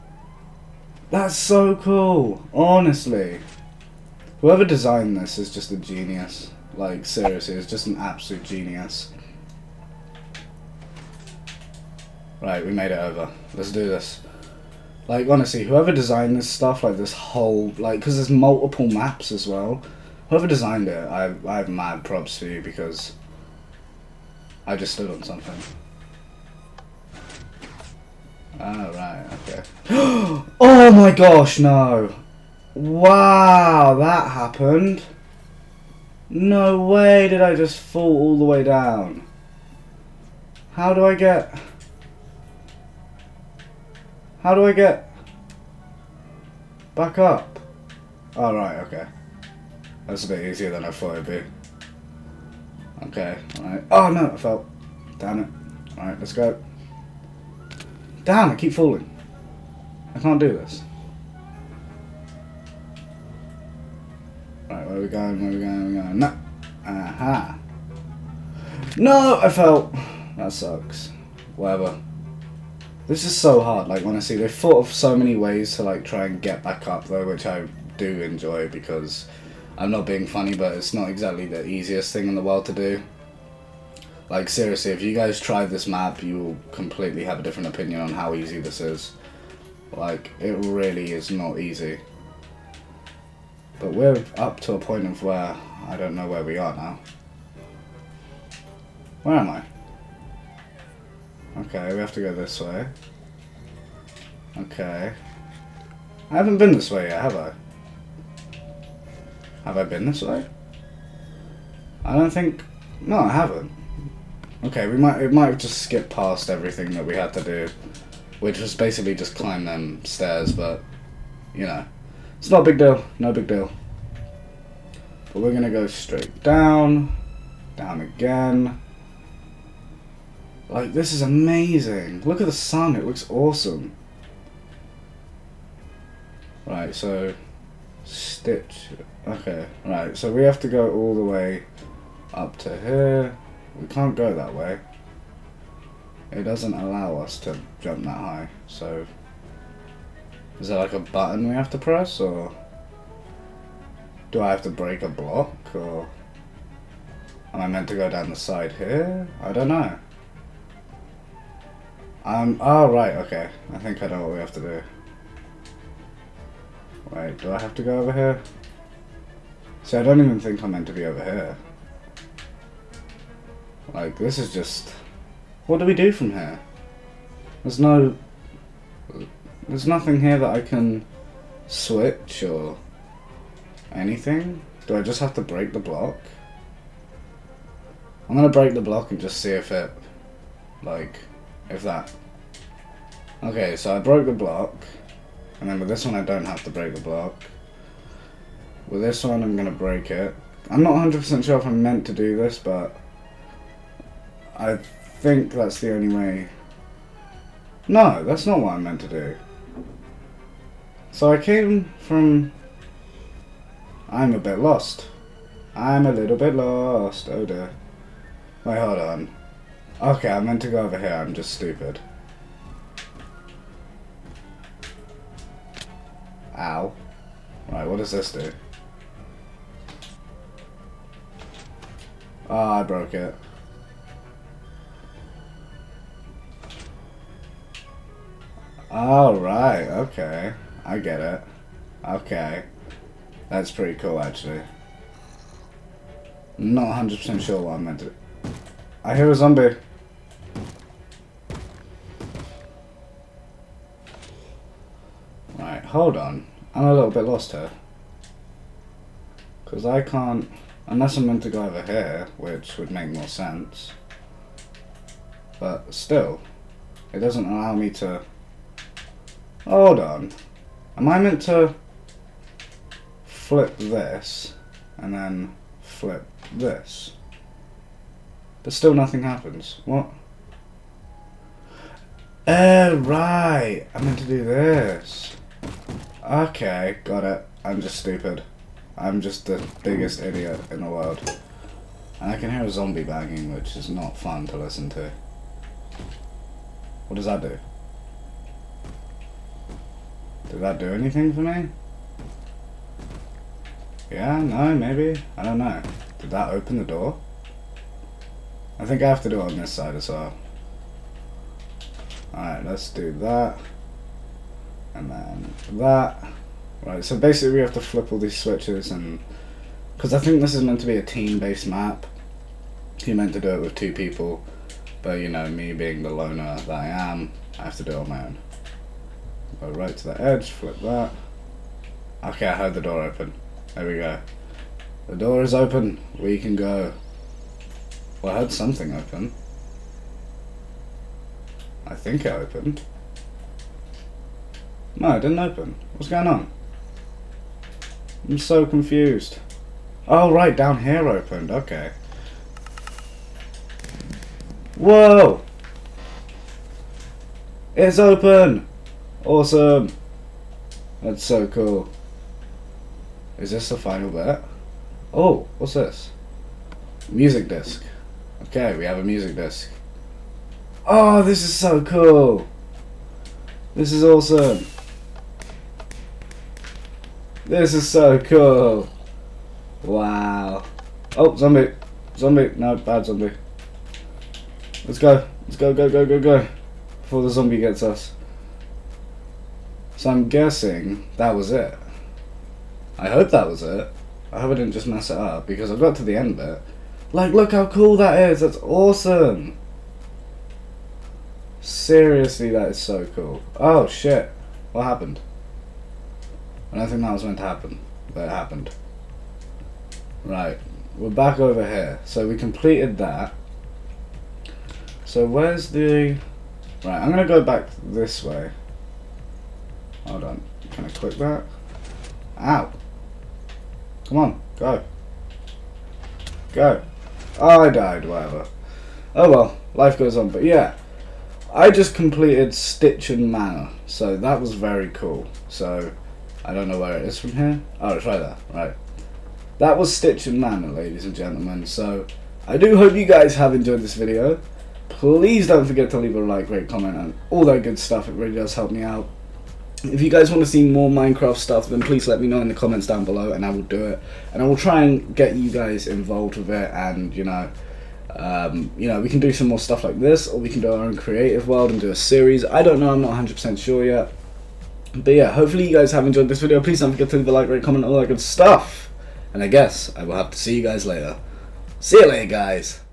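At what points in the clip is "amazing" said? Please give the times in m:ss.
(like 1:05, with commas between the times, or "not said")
2:11.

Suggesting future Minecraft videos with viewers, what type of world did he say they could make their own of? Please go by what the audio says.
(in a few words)
creative world.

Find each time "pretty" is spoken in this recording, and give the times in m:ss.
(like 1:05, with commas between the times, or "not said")
4:03.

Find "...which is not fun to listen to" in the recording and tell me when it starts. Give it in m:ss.
4:53.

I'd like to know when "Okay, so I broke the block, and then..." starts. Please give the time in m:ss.
3:13.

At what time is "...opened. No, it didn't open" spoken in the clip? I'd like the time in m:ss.
5:42.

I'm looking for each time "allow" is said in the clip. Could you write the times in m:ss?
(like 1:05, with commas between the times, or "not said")
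2:26, 4:27.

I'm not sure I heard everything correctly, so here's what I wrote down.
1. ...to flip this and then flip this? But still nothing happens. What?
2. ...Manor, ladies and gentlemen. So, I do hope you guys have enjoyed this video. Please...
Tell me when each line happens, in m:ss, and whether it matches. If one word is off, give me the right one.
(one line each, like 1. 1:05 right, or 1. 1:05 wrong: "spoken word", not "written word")
1. 4:31 right
2. 7:20 right.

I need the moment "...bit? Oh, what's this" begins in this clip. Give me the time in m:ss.
6:04.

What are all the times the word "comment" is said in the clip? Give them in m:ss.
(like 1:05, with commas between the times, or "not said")
7:26, 7:32, 7:47.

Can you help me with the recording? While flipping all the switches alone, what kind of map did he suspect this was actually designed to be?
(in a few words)
team-based map.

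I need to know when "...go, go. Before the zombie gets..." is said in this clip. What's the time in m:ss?
6:26.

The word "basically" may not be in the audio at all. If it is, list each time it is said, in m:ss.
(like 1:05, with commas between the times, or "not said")
1:58, 5:17.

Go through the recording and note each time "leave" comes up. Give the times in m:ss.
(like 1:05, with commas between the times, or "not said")
7:25, 7:47.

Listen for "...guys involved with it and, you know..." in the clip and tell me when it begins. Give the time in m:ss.
7:35.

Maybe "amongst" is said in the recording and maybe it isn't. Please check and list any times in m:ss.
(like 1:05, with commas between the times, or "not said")
not said.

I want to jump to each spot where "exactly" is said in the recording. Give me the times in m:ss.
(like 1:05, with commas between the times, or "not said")
1:21.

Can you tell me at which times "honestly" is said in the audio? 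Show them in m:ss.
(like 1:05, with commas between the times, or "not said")
0:02, 0:15, 1:14.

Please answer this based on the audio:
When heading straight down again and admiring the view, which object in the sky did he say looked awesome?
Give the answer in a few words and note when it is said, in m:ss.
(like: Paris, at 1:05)
the sun, at 2:12.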